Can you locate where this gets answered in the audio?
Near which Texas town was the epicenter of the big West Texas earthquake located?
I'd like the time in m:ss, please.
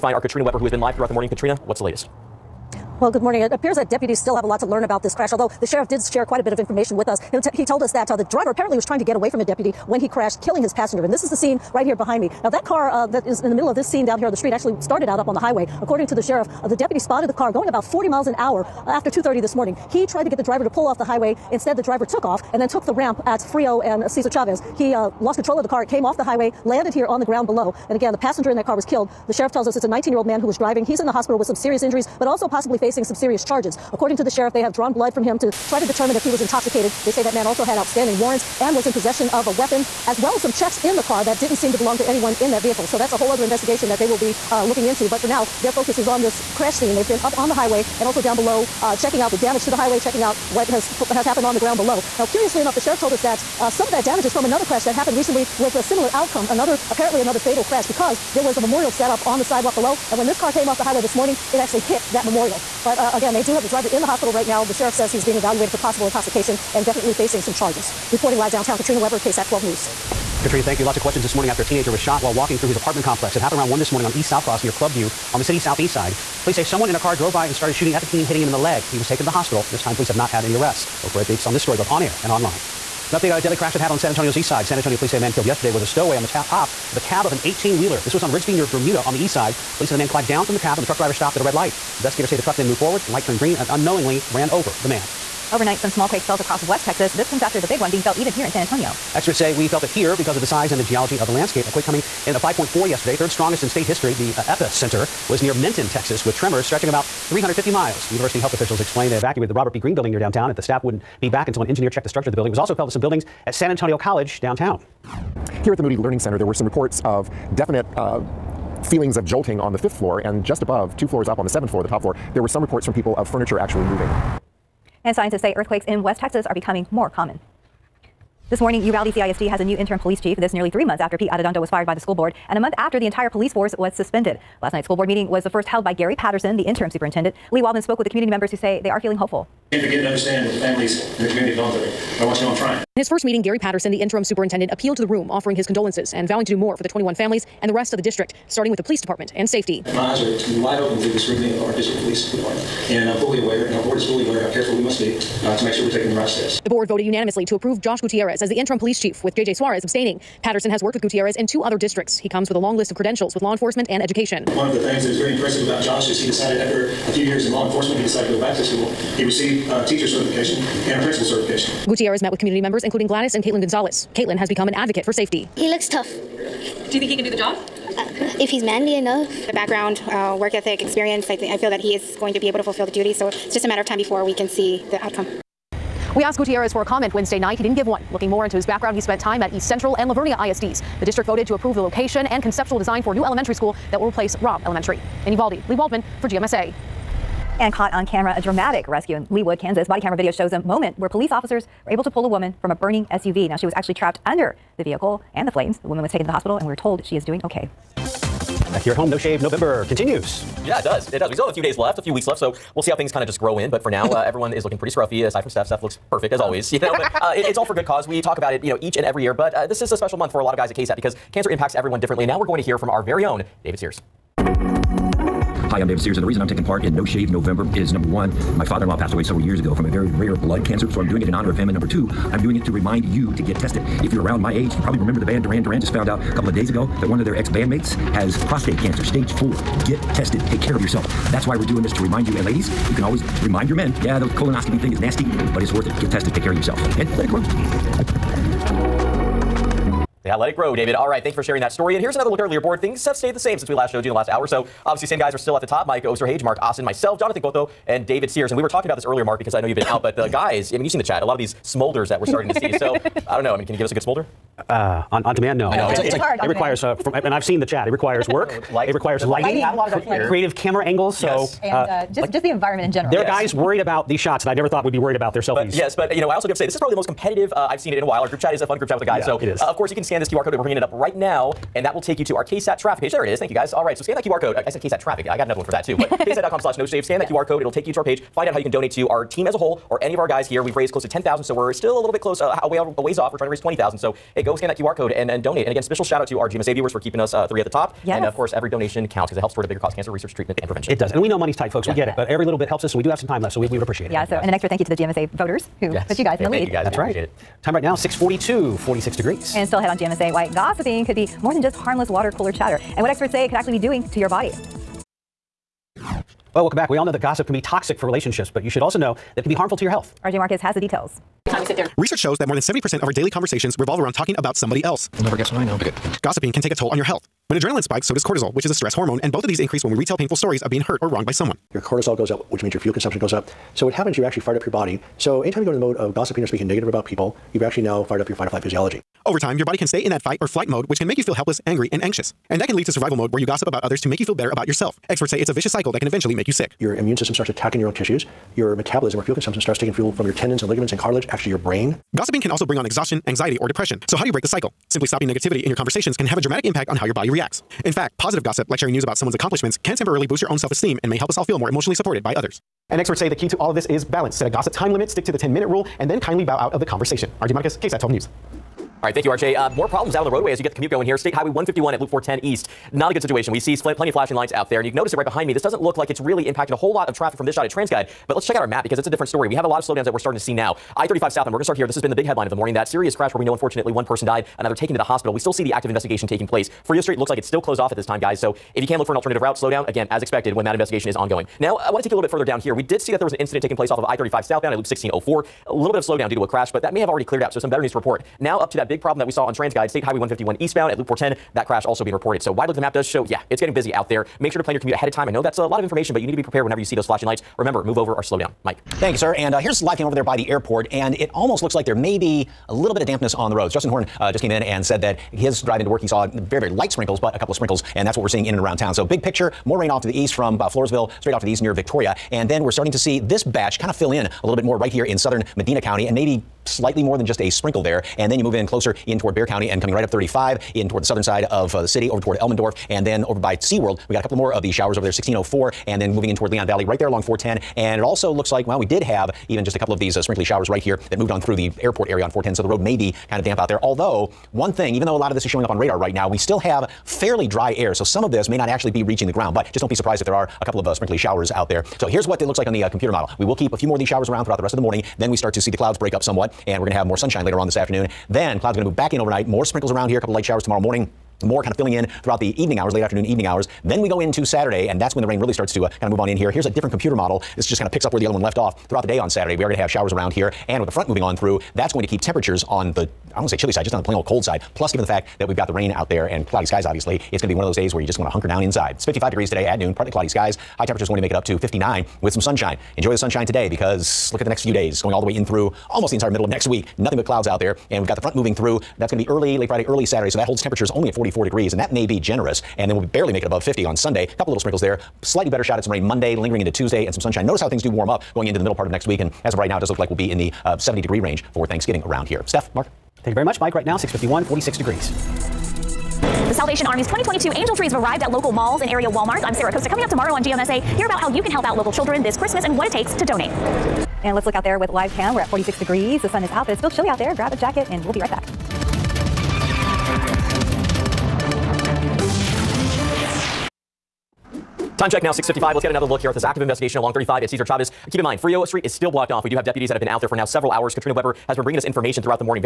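1:45.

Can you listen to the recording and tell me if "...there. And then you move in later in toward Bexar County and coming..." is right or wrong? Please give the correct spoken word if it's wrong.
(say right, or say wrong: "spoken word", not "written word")
wrong: "closer", not "later".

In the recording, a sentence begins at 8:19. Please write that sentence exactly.
And as of right now, it does look like we'll be in the uh, 70 degree range for Thanksgiving around here.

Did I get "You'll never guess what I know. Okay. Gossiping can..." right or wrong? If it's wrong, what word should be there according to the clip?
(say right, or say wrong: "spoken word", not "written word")
right.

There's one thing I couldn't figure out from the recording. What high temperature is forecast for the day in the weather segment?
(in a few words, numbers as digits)
59.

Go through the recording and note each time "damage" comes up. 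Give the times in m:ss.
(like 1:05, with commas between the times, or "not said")
0:49, 0:54.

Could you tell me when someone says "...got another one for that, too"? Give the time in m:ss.
4:45.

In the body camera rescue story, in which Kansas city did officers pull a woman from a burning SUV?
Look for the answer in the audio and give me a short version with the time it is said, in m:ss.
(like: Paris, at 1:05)
Leawood, at 3:19.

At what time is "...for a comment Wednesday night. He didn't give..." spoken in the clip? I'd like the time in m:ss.
3:06.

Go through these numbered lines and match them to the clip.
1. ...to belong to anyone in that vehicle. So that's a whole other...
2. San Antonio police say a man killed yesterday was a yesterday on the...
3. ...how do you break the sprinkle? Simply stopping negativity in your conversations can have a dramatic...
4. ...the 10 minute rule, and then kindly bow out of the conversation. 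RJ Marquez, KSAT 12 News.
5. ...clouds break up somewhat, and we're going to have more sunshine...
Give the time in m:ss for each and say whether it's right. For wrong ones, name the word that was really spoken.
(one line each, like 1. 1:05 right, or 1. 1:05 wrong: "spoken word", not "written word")
1. 0:41 right
2. 1:24 wrong: "stowaway", not "yesterday"
3. 5:54 wrong: "cycle", not "sprinkle"
4. 6:05 right
5. 7:35 right.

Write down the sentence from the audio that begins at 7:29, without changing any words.
But just don't be surprised if there are a couple of uh, sprinkly showers out there.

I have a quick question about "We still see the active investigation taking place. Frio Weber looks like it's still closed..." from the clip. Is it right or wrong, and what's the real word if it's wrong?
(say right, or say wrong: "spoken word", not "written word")
wrong: "Street", not "Weber".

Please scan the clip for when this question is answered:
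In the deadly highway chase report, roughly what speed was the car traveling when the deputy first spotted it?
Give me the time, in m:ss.
0:17.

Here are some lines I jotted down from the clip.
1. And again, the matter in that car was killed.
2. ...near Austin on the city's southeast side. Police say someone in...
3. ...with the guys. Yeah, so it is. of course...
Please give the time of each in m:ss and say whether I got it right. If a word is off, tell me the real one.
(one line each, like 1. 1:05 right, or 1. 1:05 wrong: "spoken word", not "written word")
1. 0:27 wrong: "passenger", not "matter"
2. 1:14 wrong: "Clubview", not "Austin"
3. 4:38 right.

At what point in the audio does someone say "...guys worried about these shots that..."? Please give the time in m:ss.
4:33.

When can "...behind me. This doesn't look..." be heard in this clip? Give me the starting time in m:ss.
6:15.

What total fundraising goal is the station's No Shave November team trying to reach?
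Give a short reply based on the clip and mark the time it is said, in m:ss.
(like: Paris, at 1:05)
20000, at 4:53.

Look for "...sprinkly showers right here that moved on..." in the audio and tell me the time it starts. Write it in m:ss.
7:20.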